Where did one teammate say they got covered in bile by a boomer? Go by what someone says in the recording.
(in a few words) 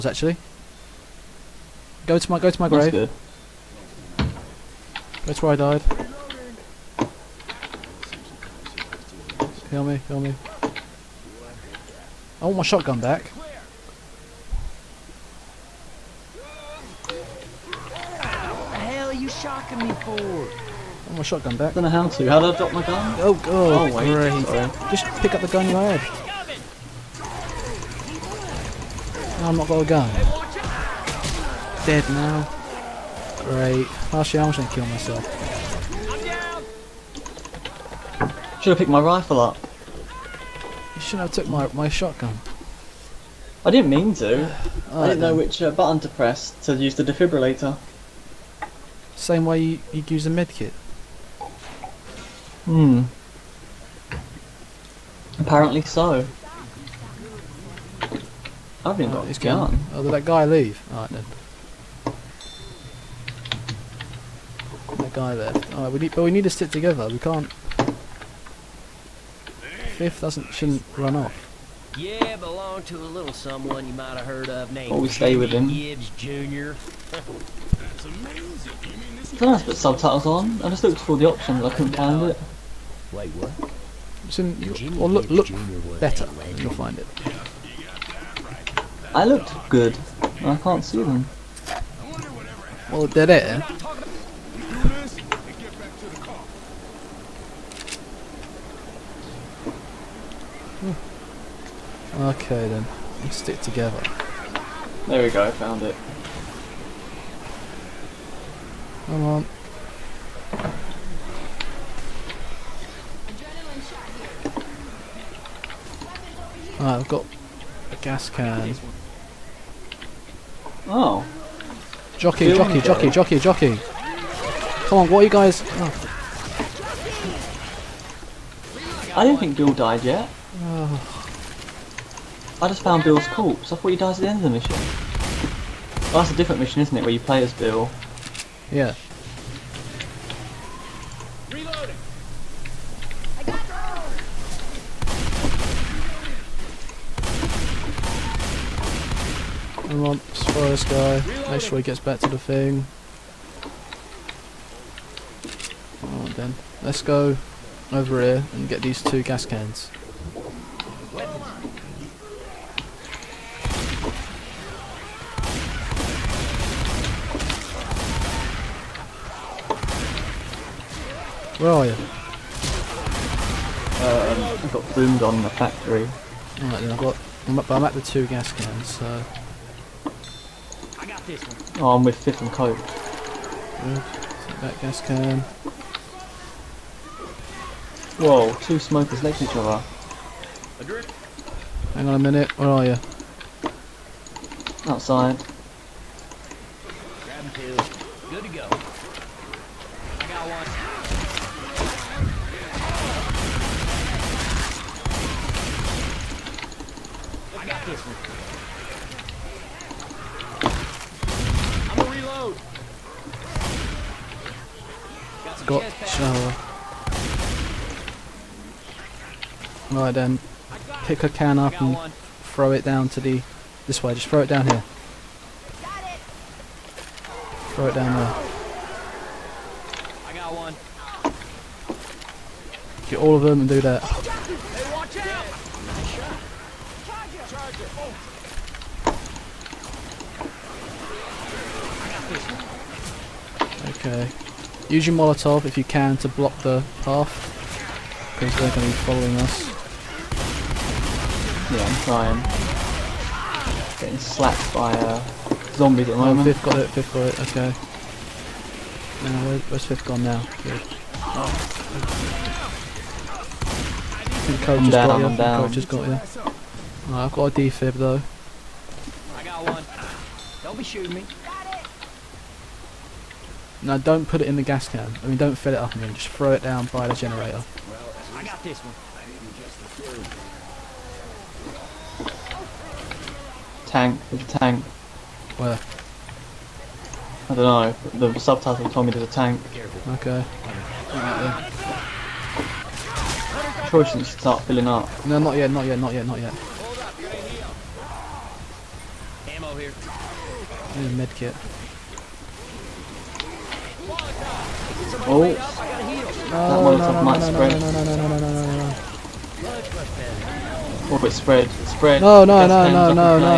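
the factory.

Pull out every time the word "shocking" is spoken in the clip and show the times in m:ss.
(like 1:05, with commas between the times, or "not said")
0:19.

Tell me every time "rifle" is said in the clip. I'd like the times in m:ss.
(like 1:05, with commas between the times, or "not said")
0:39.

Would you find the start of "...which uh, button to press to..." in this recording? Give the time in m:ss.
0:45.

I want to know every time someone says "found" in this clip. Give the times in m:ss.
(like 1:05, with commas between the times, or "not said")
1:45, 2:12.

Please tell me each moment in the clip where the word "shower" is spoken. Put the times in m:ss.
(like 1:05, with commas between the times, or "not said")
3:36.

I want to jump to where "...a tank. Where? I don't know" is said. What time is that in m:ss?
4:44.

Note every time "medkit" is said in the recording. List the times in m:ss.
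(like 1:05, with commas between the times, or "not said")
0:50, 5:01.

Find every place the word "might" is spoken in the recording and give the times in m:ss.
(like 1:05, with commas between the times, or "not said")
1:13, 5:07.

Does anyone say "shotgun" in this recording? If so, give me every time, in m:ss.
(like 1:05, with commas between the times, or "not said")
0:12, 0:21, 0:41.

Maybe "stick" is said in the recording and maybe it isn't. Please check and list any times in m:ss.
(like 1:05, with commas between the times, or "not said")
1:06, 1:43.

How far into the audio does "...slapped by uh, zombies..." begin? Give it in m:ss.
4:14.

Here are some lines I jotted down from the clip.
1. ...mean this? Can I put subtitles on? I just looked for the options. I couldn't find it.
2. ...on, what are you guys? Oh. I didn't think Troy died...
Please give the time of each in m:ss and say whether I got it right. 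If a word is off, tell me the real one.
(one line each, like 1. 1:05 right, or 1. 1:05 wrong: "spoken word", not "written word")
1. 1:18 right
2. 2:04 wrong: "Bill", not "Troy".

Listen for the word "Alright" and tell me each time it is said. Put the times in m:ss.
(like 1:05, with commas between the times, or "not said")
1:00, 1:05, 2:36, 2:56.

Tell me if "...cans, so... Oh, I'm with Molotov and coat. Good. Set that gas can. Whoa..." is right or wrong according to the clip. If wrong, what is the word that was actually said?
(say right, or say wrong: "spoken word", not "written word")
wrong: "Fifth", not "Molotov".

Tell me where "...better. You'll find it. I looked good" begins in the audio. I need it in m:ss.
1:26.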